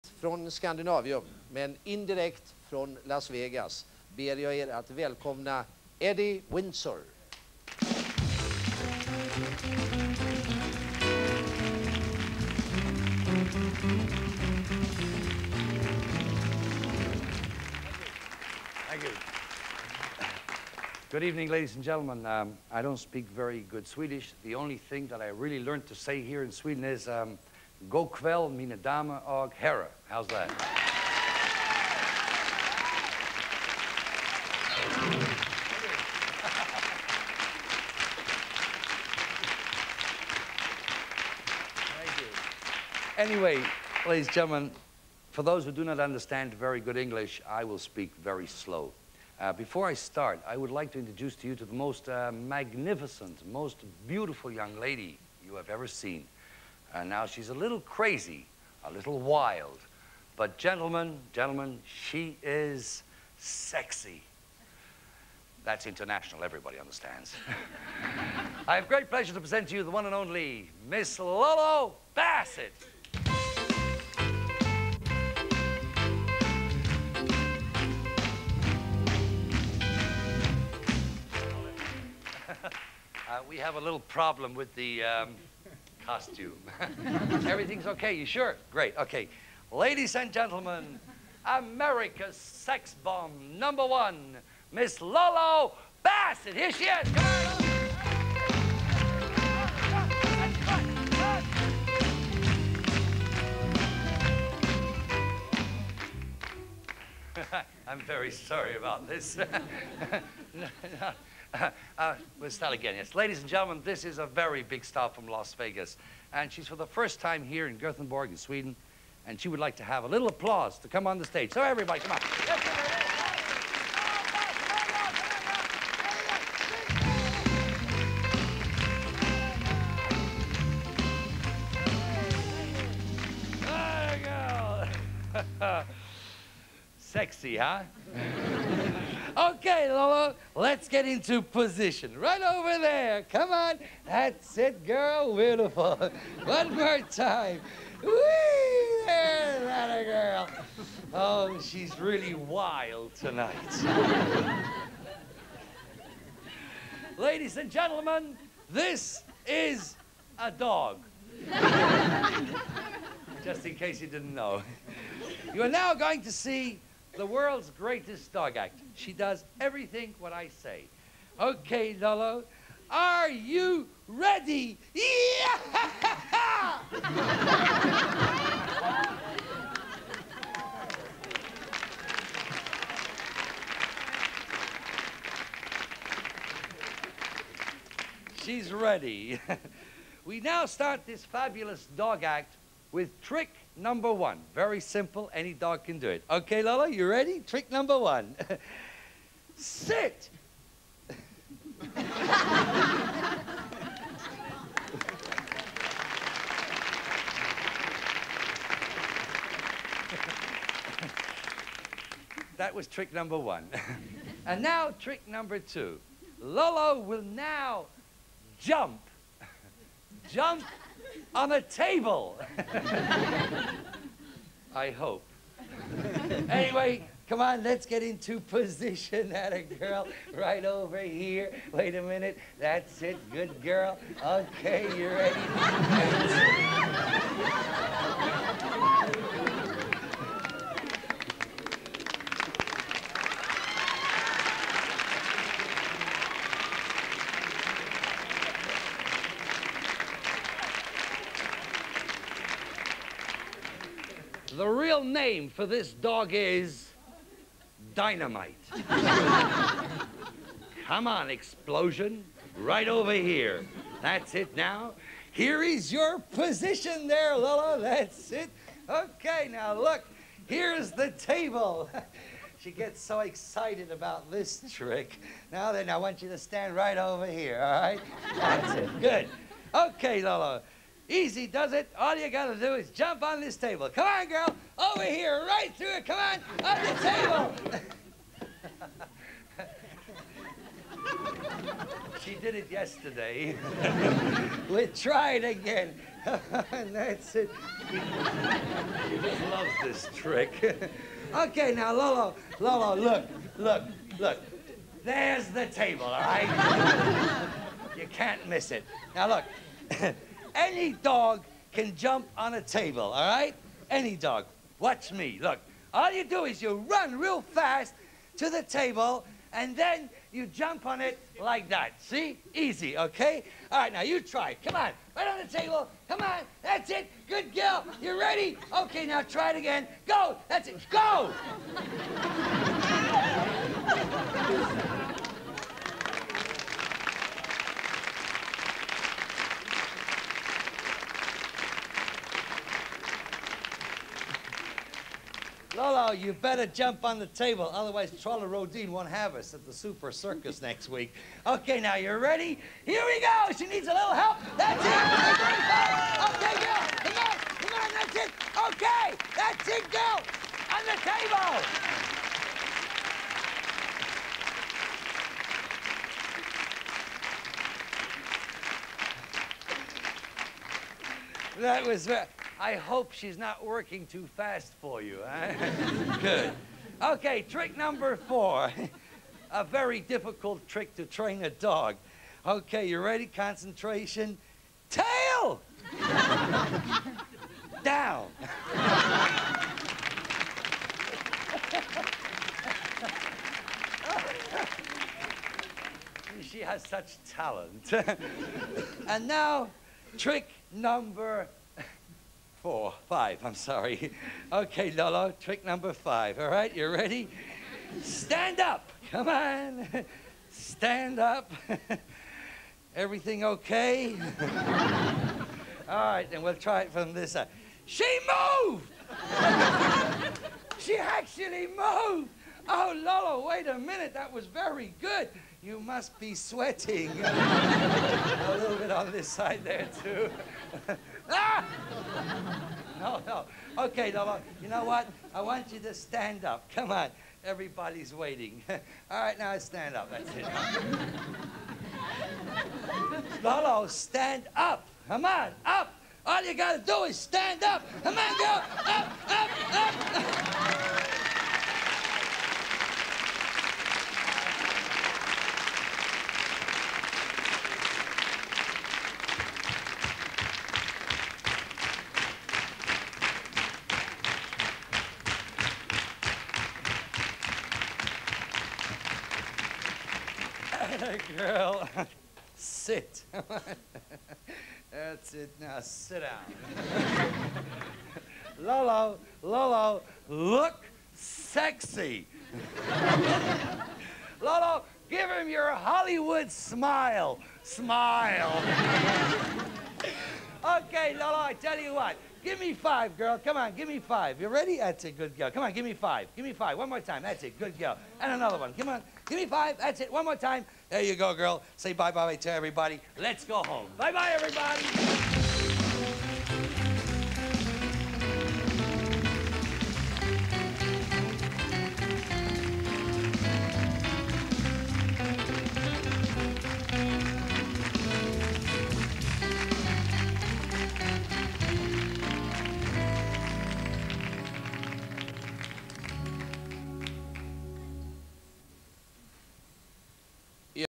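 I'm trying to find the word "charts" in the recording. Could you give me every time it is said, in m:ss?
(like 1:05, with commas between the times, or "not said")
not said.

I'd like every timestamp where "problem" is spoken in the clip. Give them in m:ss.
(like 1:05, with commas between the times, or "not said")
1:24.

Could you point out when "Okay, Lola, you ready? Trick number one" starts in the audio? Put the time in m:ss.
3:16.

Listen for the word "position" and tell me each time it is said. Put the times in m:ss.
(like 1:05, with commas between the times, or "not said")
2:21, 3:48, 4:26.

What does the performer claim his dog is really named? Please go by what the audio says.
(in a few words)
Dynamite.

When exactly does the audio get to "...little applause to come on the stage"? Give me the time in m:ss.
2:00.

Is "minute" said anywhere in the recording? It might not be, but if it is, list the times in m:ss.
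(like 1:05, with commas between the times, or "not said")
3:52, 7:03.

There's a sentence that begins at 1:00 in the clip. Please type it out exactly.
But gentlemen, gentlemen, she is sexy.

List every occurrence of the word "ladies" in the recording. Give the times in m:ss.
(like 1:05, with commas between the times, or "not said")
0:21, 0:44, 1:29, 1:53, 2:37.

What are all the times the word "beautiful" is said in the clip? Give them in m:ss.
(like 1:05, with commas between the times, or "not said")
0:54, 2:25.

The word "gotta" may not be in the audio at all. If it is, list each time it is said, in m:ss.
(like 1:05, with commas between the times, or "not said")
4:42, 7:26.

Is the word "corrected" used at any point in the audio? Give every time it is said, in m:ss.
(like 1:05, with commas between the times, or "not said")
not said.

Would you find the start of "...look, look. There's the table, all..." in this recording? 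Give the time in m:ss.
5:03.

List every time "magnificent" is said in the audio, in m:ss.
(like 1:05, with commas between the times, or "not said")
0:52.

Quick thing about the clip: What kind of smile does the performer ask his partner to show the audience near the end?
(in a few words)
Hollywood smile.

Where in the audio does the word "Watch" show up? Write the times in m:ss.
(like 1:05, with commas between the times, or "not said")
5:14.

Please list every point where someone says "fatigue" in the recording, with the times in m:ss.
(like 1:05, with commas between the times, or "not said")
not said.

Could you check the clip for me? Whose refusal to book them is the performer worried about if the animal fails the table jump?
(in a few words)
Trolle Rhodin.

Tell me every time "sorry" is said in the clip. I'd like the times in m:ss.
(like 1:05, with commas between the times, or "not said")
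1:48, 6:43.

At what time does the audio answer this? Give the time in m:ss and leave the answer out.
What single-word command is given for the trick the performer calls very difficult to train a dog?
6:24.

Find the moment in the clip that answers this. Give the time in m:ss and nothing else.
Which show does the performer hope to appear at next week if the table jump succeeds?
5:49.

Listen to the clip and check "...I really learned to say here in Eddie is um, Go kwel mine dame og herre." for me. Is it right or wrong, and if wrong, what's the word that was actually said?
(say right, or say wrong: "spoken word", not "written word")
wrong: "Sweden", not "Eddie".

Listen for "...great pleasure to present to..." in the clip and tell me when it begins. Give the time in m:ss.
1:08.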